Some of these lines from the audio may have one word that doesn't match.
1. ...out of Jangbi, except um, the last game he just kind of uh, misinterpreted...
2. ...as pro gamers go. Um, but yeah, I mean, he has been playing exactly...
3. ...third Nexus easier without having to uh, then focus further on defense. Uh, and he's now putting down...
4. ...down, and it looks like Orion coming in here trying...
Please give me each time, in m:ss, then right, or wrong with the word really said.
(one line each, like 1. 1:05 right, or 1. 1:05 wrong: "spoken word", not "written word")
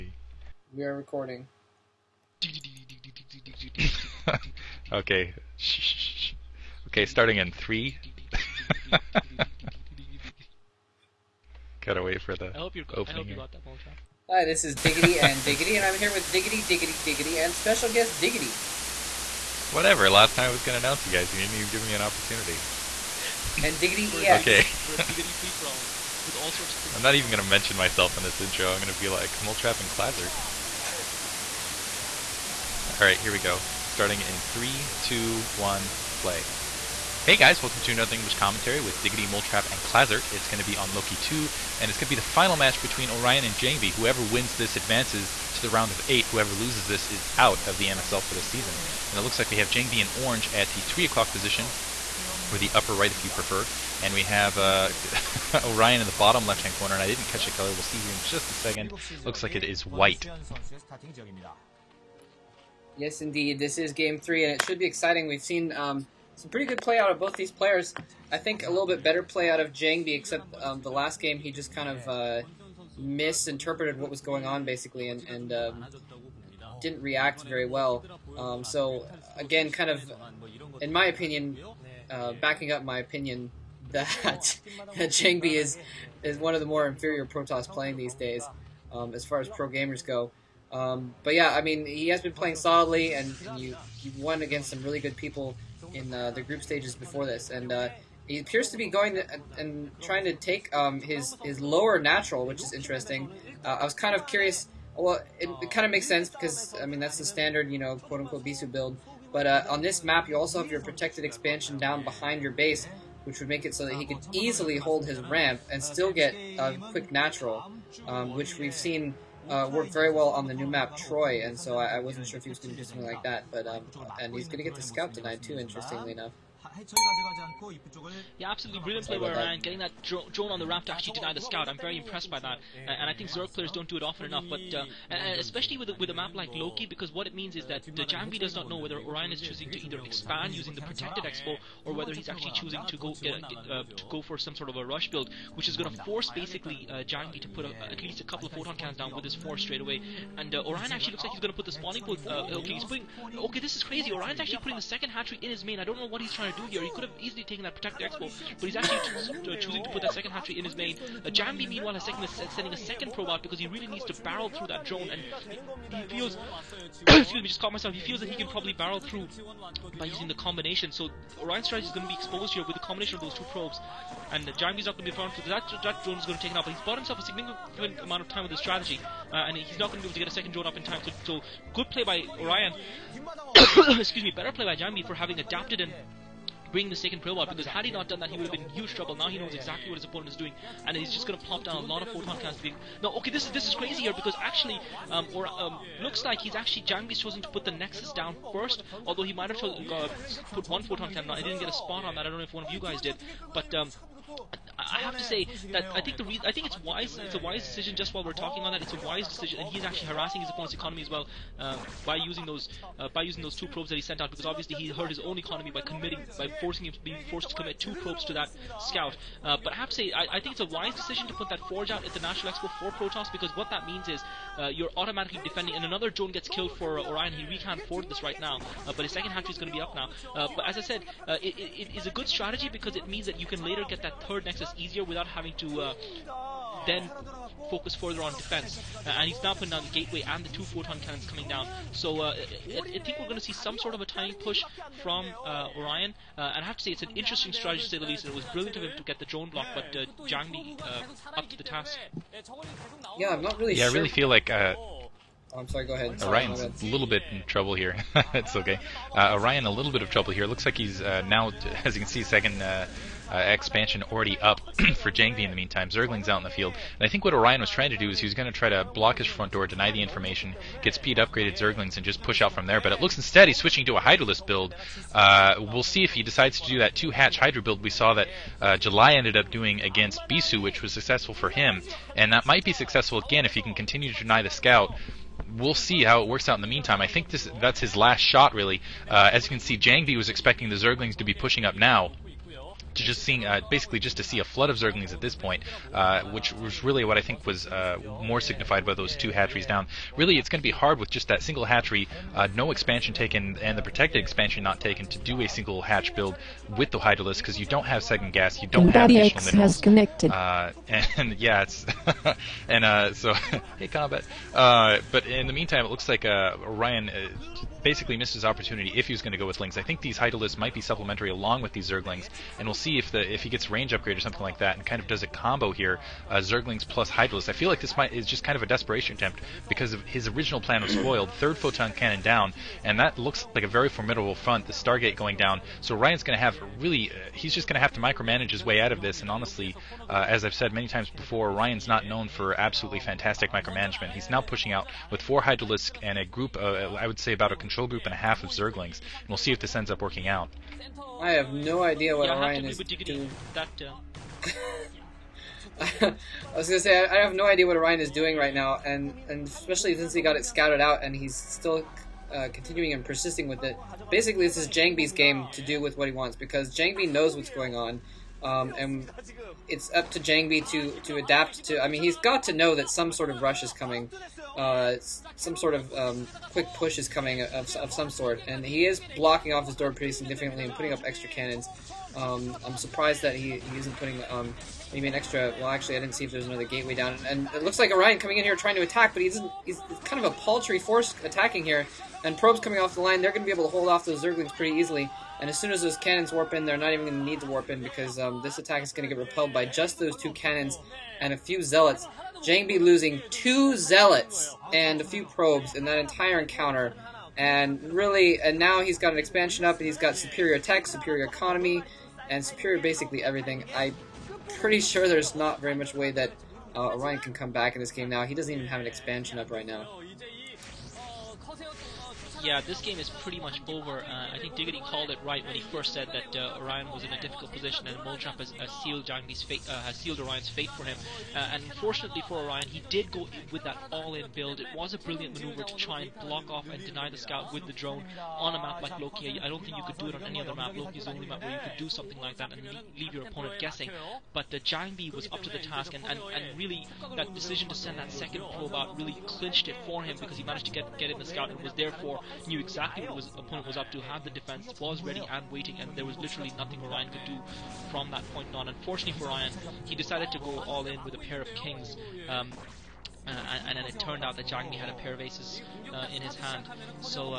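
1. 1:09 right
2. 1:29 wrong: "solidly", not "exactly"
3. 3:54 right
4. 6:26 right.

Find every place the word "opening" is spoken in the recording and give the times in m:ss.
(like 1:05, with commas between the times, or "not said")
0:12.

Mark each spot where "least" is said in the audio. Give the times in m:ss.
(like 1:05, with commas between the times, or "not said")
2:28, 4:08.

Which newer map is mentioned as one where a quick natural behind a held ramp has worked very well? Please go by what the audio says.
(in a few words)
Troy.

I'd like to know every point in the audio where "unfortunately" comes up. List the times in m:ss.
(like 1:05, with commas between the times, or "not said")
7:11, 7:38.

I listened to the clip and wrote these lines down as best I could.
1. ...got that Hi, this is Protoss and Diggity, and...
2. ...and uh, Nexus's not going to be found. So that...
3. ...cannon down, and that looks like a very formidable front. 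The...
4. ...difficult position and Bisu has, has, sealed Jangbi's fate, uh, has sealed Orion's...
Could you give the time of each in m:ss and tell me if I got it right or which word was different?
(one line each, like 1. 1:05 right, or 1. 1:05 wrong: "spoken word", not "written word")
1. 0:13 wrong: "Diggity", not "Protoss"
2. 2:54 wrong: "Jangbi", not "Nexus"
3. 5:31 right
4. 7:07 wrong: "Molchamp", not "Bisu".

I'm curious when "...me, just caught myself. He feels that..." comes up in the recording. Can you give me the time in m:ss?
2:47.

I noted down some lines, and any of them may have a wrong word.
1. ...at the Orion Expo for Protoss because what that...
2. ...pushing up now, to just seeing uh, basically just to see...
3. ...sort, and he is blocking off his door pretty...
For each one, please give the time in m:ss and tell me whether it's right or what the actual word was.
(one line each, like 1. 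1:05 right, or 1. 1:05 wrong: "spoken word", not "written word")
1. 3:42 wrong: "National", not "Orion"
2. 4:51 right
3. 6:18 right.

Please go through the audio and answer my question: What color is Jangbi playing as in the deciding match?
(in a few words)
orange.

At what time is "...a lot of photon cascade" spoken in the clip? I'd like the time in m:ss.
3:11.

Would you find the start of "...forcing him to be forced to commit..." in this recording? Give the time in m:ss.
3:36.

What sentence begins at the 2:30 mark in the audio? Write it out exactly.
And uh, Orion actually looks like he's going to put the spawning pool.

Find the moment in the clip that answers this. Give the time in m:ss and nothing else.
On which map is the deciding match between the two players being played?
0:40.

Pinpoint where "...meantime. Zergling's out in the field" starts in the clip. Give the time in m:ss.
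4:25.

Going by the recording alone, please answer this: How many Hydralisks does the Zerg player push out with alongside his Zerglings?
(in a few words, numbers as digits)
4.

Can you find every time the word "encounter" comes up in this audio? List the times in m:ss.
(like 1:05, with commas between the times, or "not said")
6:46.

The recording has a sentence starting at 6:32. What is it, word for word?
And probes coming off the line, they're going to be able to hold off those Zerglings pretty easily.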